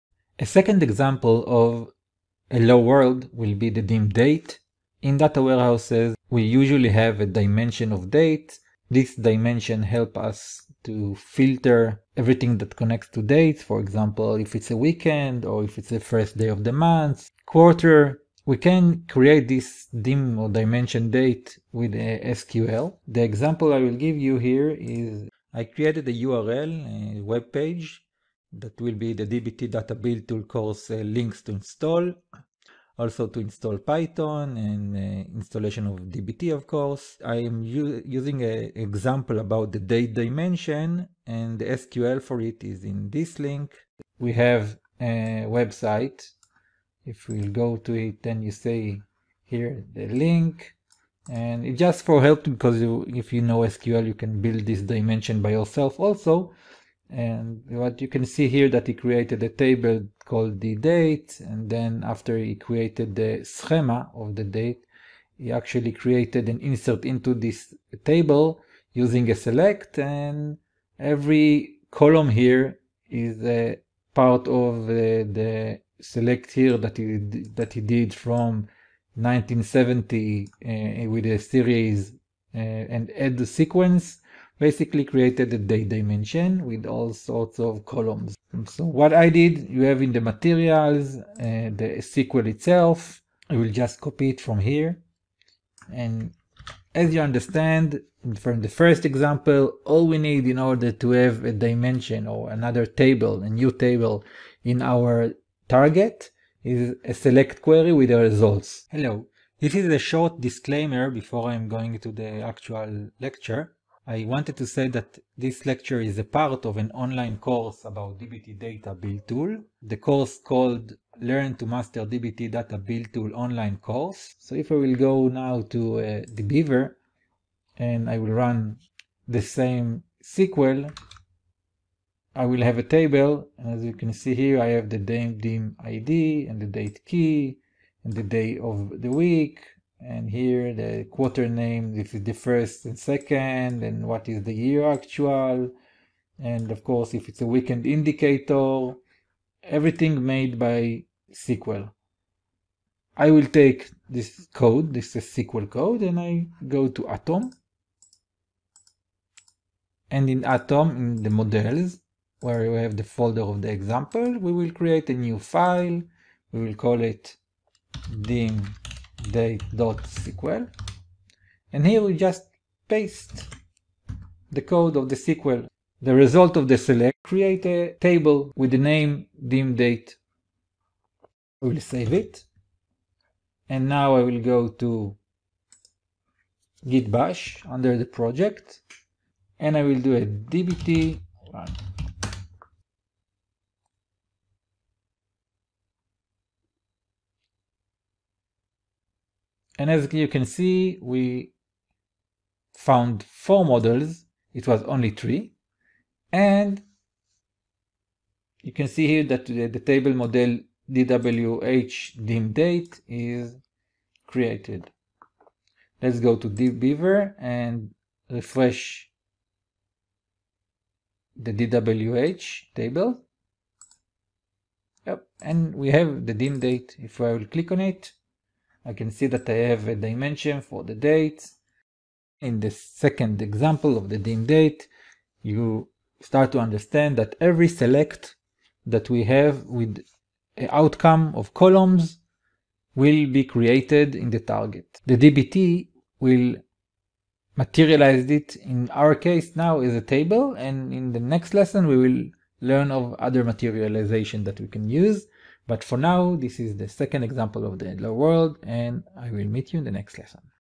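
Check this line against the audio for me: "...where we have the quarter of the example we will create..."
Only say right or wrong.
wrong.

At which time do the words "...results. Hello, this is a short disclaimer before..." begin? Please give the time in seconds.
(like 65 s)
108 s.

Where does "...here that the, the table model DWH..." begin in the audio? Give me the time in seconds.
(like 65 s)
209 s.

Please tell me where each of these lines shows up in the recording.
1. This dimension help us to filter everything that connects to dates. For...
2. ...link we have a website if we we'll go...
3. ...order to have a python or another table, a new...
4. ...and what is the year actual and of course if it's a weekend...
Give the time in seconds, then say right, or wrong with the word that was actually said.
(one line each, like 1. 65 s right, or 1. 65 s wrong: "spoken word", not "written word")
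1. 8 s right
2. 43 s right
3. 100 s wrong: "dimension", not "python"
4. 143 s right.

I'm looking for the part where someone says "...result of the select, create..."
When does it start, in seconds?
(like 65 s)
176 s.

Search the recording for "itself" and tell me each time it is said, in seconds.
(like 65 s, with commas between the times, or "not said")
92 s.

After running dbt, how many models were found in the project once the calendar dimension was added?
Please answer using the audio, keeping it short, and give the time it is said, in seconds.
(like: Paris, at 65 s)
4, at 203 s.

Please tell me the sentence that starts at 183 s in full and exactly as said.
And now I will go to git bash under the project and I will do a dbt run.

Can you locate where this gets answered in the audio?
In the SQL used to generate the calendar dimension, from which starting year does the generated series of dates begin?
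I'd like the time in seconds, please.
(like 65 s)
79 s.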